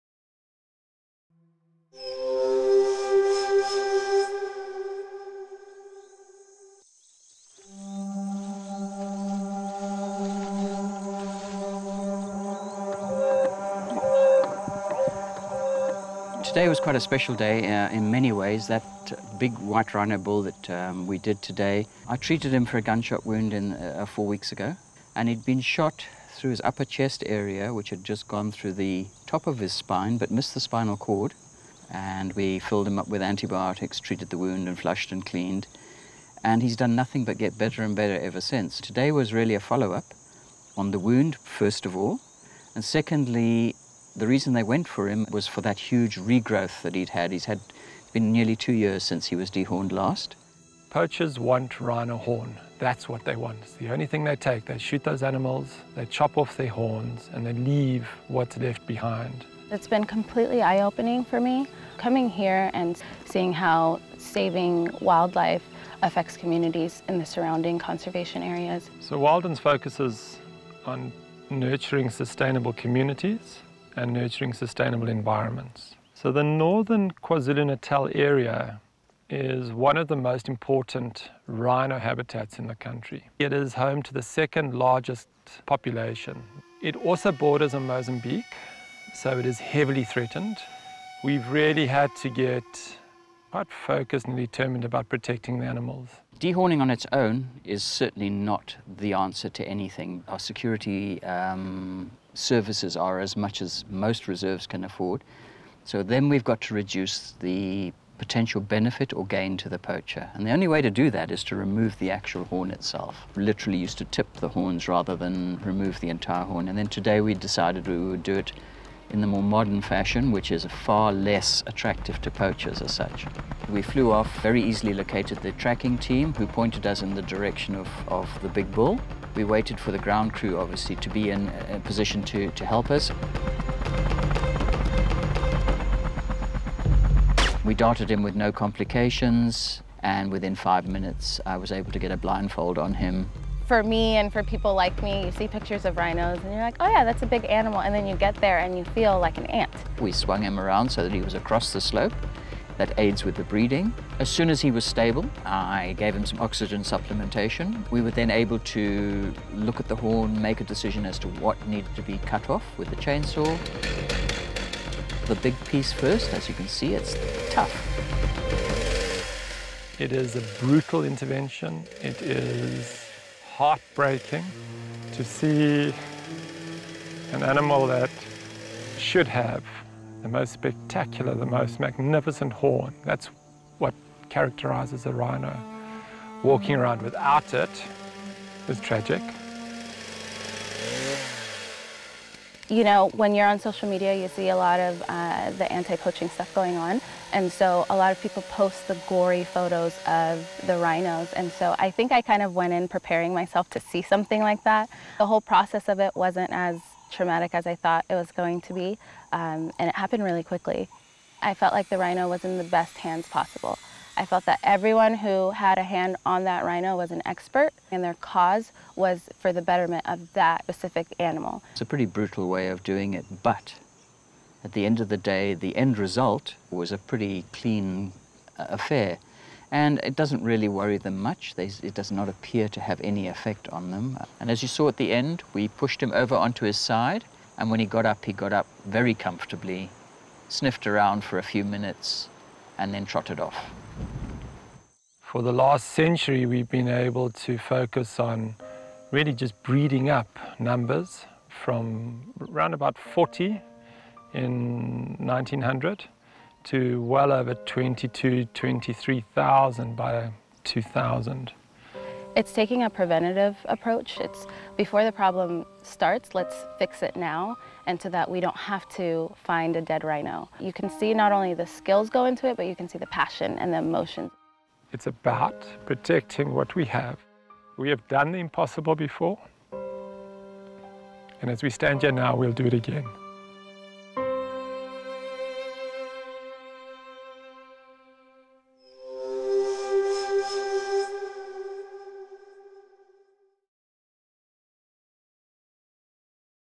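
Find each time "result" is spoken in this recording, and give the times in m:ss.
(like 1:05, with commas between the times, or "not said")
3:45.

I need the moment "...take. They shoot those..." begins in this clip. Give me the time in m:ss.
0:54.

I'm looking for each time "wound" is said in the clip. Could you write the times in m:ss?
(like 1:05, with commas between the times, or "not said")
0:23, 0:34, 0:40.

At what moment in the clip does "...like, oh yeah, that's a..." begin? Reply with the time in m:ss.
2:26.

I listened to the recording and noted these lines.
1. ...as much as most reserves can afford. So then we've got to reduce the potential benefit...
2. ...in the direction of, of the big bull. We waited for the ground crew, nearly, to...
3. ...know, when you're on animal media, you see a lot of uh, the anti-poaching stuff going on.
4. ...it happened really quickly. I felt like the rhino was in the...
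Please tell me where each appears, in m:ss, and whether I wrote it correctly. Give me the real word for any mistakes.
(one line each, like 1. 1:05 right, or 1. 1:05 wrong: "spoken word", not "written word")
1. 1:43 right
2. 2:07 wrong: "obviously", not "nearly"
3. 3:12 wrong: "social", not "animal"
4. 3:29 right.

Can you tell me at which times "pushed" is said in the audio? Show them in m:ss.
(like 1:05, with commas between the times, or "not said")
3:55.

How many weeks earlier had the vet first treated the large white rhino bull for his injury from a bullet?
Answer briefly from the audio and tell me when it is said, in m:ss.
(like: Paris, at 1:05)
4 weeks, at 0:24.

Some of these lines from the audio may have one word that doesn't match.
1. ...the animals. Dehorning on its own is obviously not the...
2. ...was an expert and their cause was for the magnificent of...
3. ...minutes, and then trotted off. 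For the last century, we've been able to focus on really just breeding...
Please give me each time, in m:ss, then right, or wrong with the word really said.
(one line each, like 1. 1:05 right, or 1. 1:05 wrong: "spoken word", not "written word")
1. 1:35 wrong: "certainly", not "obviously"
2. 3:36 wrong: "betterment", not "magnificent"
3. 4:01 right.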